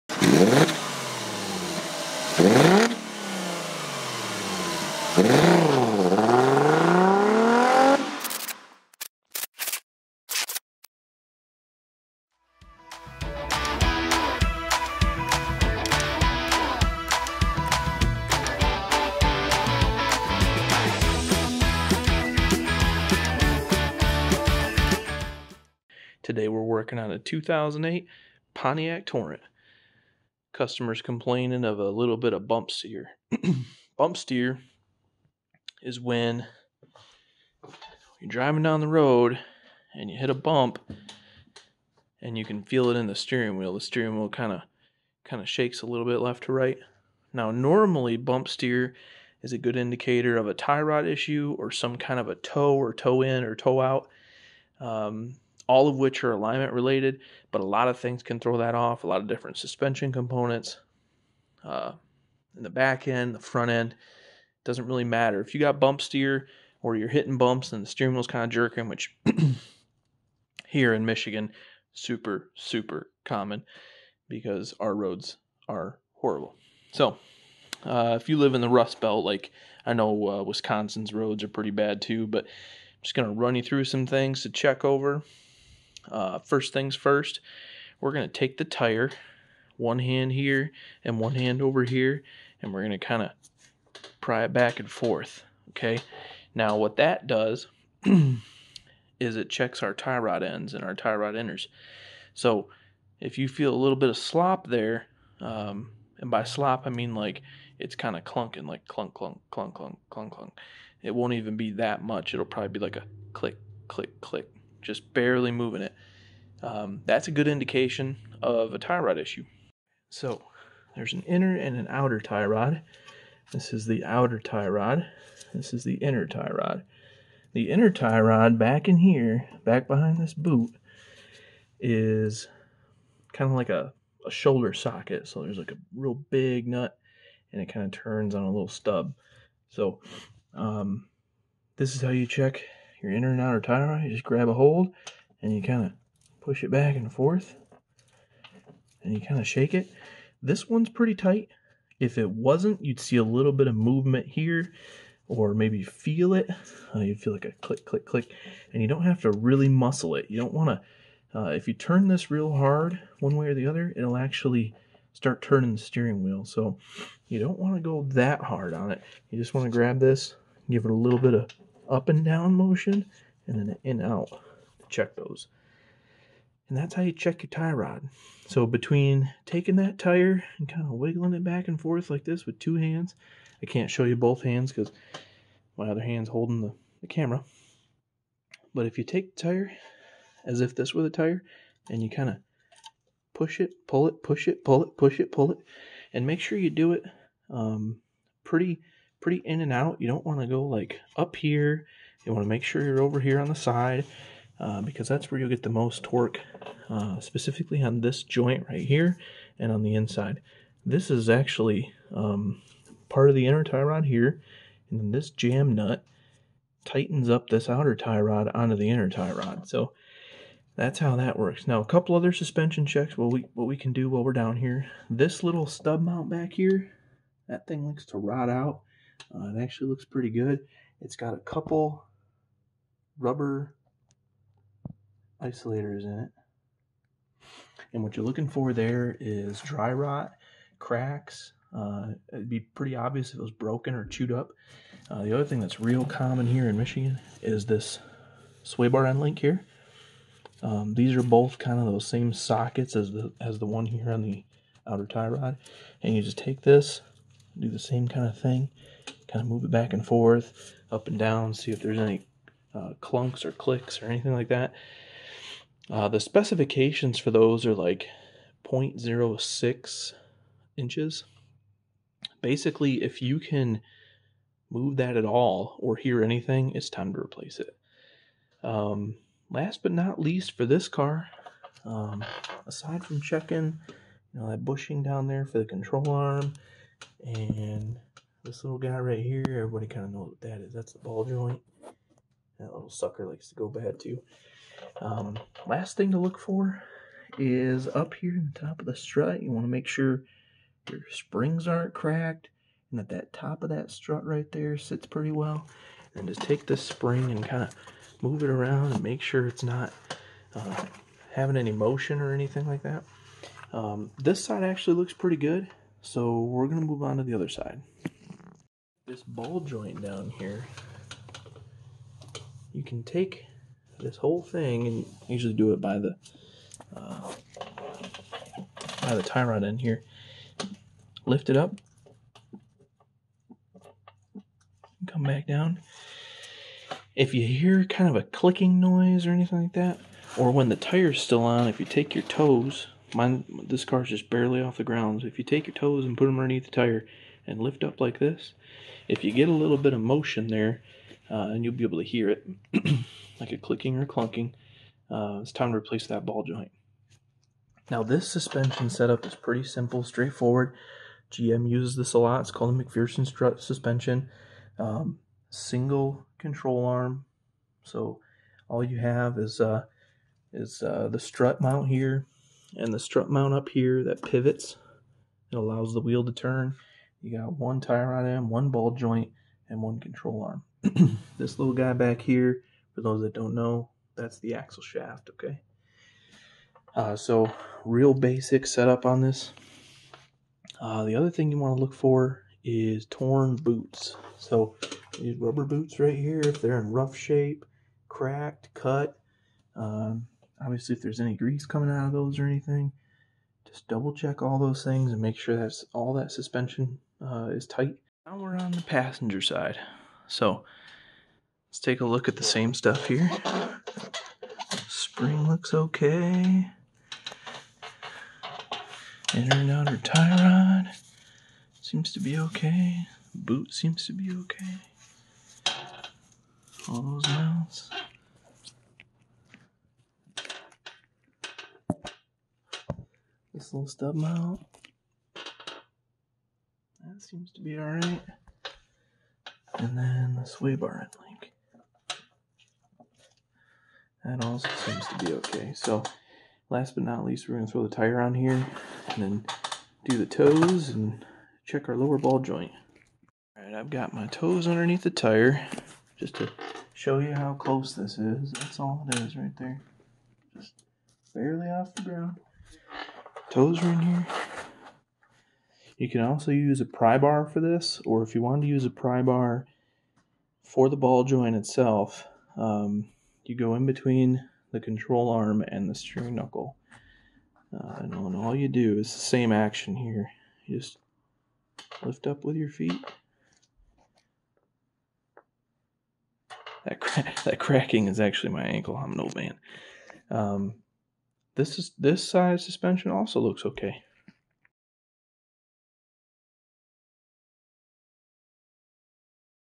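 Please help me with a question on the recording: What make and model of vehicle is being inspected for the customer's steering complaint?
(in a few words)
2008 Pontiac Torrent.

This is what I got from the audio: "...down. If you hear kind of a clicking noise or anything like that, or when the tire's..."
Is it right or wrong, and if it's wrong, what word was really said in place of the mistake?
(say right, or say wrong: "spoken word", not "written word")
right.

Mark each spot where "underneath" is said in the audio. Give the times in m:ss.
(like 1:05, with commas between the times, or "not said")
5:46, 7:34.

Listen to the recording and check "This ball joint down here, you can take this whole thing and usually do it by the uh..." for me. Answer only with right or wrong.
right.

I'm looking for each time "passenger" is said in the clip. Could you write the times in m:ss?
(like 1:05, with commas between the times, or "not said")
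6:48.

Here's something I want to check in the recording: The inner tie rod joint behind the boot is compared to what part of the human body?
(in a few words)
shoulder socket.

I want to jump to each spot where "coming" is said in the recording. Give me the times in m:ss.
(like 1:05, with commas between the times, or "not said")
6:41.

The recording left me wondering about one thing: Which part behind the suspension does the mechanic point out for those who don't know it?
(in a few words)
axle shaft.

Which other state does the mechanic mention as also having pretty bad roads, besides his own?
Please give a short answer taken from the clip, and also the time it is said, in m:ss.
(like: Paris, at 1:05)
Wisconsin, at 1:20.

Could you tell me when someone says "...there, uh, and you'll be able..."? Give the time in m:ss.
5:50.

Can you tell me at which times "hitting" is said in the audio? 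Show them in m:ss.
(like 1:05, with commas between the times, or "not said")
1:07.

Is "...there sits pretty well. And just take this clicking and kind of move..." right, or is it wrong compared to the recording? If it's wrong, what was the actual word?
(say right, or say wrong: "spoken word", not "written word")
wrong: "spring", not "clicking".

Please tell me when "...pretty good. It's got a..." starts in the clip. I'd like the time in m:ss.
3:50.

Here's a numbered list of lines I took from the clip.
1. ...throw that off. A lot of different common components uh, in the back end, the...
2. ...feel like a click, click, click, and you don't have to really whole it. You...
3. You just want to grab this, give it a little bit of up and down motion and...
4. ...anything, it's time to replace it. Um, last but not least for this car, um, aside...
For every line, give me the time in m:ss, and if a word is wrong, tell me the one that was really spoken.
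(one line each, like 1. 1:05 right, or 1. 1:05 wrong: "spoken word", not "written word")
1. 0:58 wrong: "suspension", not "common"
2. 2:37 wrong: "muscle", not "whole"
3. 2:49 right
4. 4:36 right.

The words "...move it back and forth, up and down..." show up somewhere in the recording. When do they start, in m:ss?
4:19.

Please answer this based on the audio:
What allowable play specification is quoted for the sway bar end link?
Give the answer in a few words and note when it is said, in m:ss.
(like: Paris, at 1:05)
0.06 inches, at 4:28.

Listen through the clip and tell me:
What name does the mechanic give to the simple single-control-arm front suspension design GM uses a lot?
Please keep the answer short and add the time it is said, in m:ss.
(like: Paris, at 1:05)
McPherson strut suspension, at 6:02.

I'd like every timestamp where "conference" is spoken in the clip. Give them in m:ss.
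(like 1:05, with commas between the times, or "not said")
not said.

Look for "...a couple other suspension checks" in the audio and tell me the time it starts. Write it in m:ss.
3:41.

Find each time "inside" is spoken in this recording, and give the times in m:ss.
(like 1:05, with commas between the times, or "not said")
3:29.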